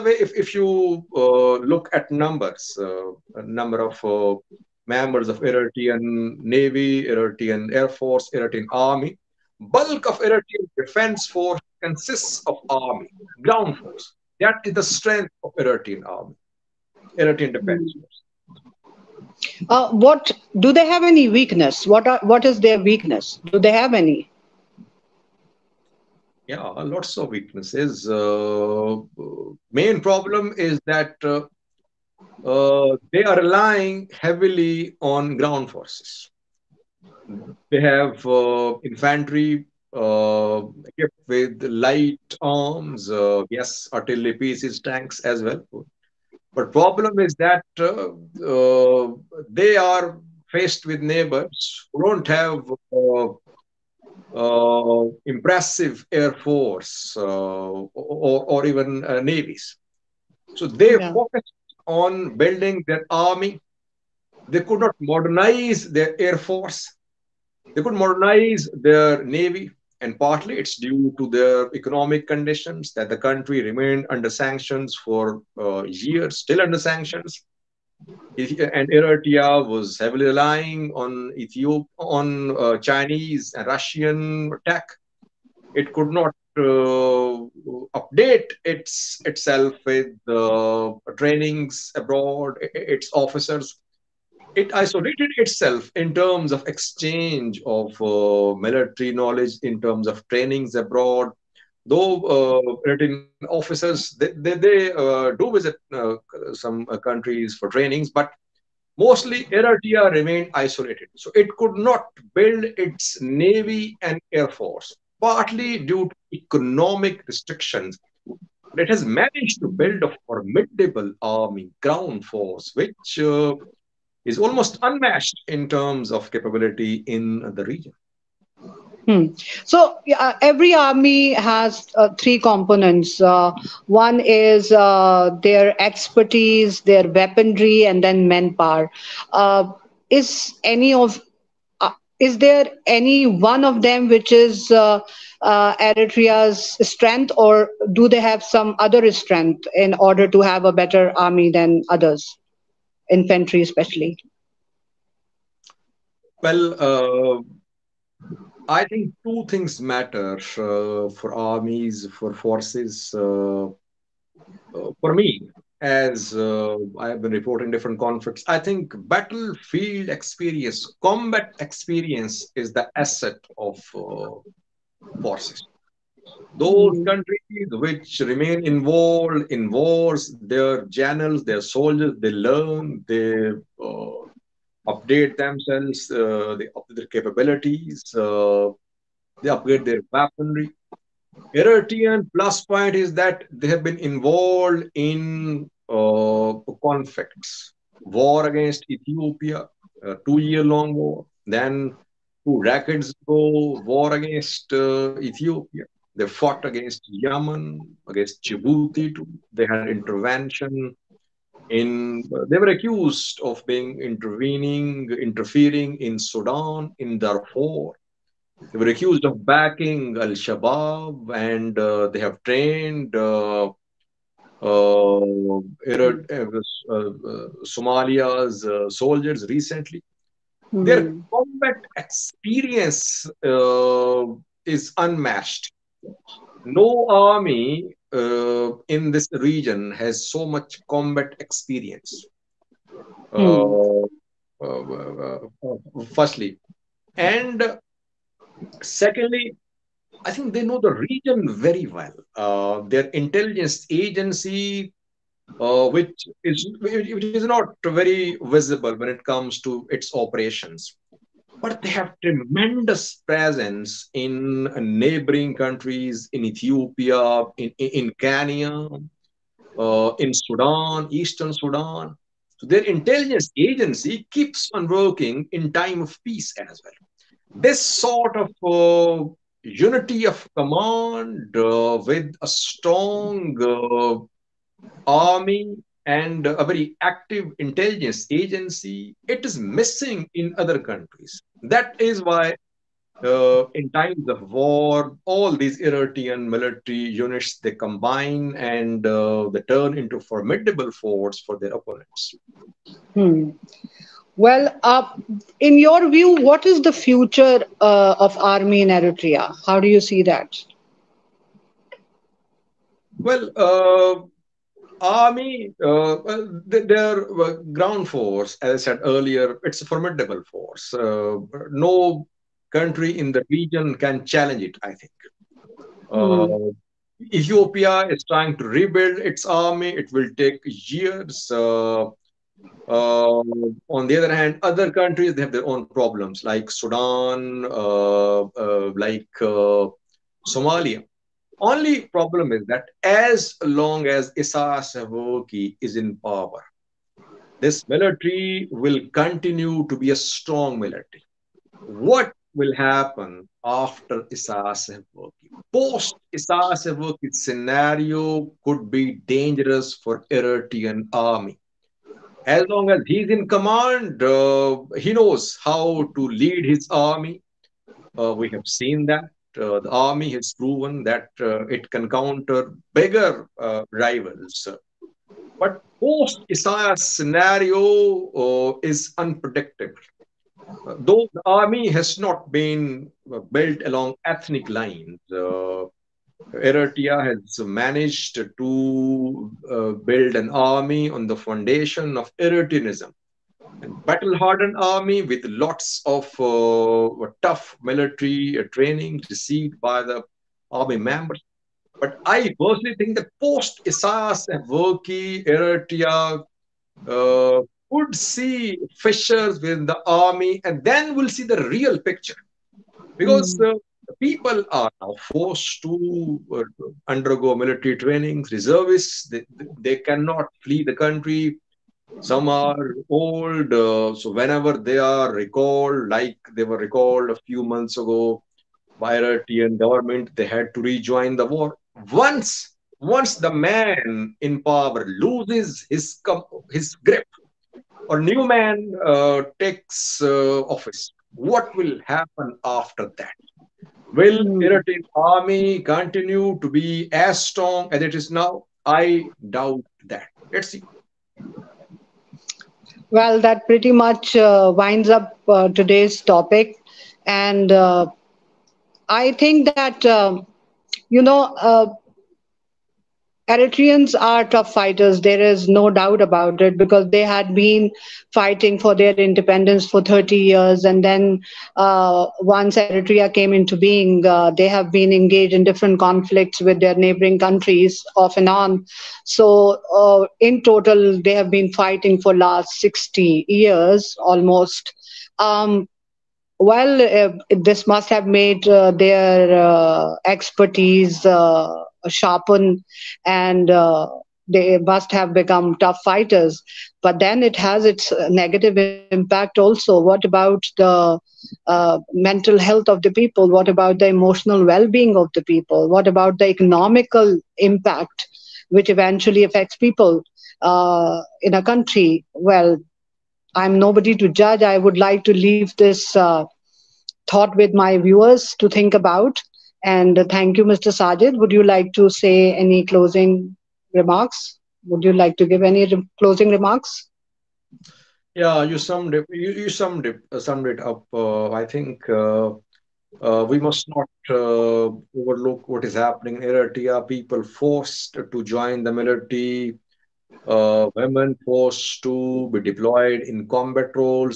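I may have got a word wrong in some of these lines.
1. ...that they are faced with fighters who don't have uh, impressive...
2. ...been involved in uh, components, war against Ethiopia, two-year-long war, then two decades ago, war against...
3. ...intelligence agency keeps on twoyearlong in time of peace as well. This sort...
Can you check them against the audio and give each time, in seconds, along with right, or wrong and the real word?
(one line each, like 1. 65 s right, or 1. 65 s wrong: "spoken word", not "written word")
1. 47 s wrong: "neighbors", not "fighters"
2. 193 s wrong: "conflicts", not "components"
3. 272 s wrong: "working", not "twoyearlong".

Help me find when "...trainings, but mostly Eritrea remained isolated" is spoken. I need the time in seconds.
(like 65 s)
107 s.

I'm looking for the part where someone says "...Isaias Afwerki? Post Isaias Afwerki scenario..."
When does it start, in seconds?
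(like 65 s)
354 s.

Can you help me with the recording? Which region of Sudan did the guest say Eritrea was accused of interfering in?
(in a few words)
Darfur.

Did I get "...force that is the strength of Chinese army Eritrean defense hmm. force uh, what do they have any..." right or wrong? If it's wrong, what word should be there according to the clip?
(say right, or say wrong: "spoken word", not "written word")
wrong: "Eritrean", not "Chinese".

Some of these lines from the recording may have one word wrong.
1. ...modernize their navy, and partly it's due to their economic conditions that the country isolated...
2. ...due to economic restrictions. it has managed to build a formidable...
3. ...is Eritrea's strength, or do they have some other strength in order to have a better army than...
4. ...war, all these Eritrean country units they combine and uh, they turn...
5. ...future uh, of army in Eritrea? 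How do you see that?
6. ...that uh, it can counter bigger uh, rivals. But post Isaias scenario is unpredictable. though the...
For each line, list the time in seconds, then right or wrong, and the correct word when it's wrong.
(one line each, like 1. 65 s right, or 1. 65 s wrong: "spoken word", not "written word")
1. 67 s wrong: "remained", not "isolated"
2. 115 s right
3. 144 s right
4. 294 s wrong: "military", not "country"
5. 306 s right
6. 371 s right.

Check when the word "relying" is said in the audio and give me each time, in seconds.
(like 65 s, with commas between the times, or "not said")
33 s, 80 s.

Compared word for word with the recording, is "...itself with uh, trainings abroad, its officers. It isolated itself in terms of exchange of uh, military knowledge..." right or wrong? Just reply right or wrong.
right.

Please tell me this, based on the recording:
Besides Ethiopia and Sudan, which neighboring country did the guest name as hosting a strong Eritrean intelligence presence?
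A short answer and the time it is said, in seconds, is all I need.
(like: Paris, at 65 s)
Kenya, at 268 s.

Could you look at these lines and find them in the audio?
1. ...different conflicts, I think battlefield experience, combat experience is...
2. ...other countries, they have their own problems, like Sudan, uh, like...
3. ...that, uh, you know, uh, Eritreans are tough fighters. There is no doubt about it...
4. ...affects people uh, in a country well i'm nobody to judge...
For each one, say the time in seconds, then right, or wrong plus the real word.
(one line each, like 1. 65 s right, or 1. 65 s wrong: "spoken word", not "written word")
1. 167 s right
2. 334 s right
3. 459 s right
4. 509 s right.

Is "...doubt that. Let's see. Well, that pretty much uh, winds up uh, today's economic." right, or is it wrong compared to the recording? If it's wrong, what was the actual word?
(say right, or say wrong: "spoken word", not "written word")
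wrong: "topic", not "economic".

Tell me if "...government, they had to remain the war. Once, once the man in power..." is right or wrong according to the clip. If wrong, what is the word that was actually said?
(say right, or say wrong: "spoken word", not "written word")
wrong: "rejoin", not "remain".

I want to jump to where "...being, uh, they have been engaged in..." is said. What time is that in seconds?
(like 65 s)
473 s.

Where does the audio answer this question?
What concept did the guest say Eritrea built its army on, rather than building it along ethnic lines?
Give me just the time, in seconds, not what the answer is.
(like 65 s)
392 s.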